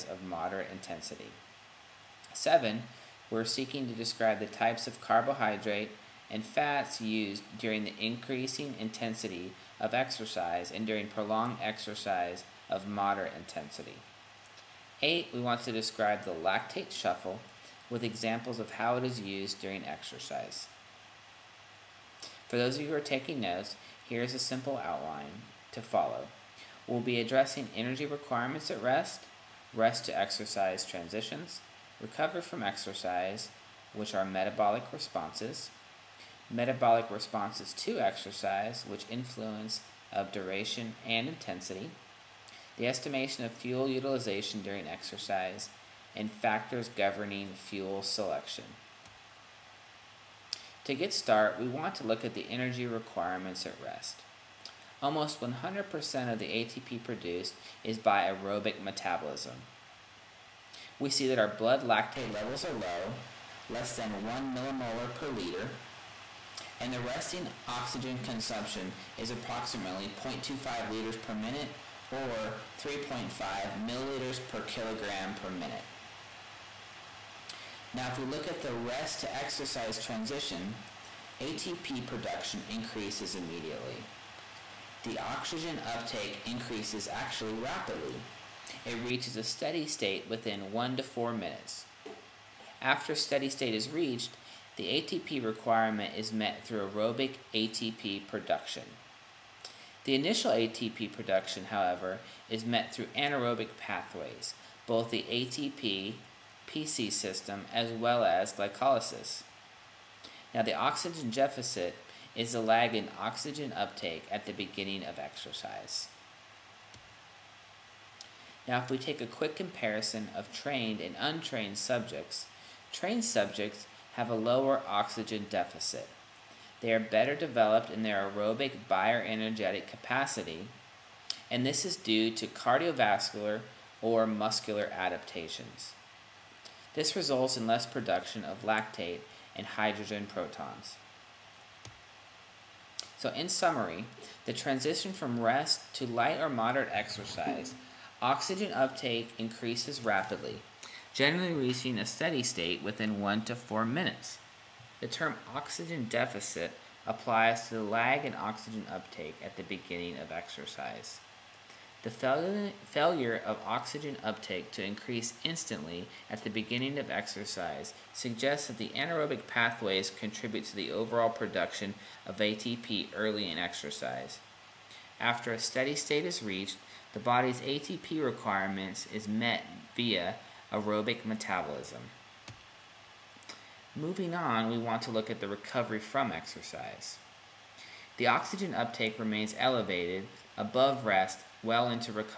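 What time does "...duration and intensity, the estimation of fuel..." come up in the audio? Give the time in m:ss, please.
0:40.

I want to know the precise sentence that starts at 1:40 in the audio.
The initial ATP production, however, is met through anaerobic pathways, both the ATP PC system as well as glycolysis.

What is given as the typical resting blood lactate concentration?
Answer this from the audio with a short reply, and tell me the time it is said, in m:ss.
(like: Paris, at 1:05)
Less than 1 millimolar per liter, at 1:03.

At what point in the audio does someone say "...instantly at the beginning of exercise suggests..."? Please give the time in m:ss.
2:45.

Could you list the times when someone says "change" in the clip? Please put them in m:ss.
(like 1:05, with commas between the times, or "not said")
not said.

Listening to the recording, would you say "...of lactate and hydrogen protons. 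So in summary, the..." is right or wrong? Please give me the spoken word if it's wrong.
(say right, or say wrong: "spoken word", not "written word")
right.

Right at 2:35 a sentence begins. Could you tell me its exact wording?
The term oxygen deficit applies to the lag in oxygen uptake at the beginning of exercise.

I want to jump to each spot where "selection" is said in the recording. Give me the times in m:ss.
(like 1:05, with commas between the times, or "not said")
0:48.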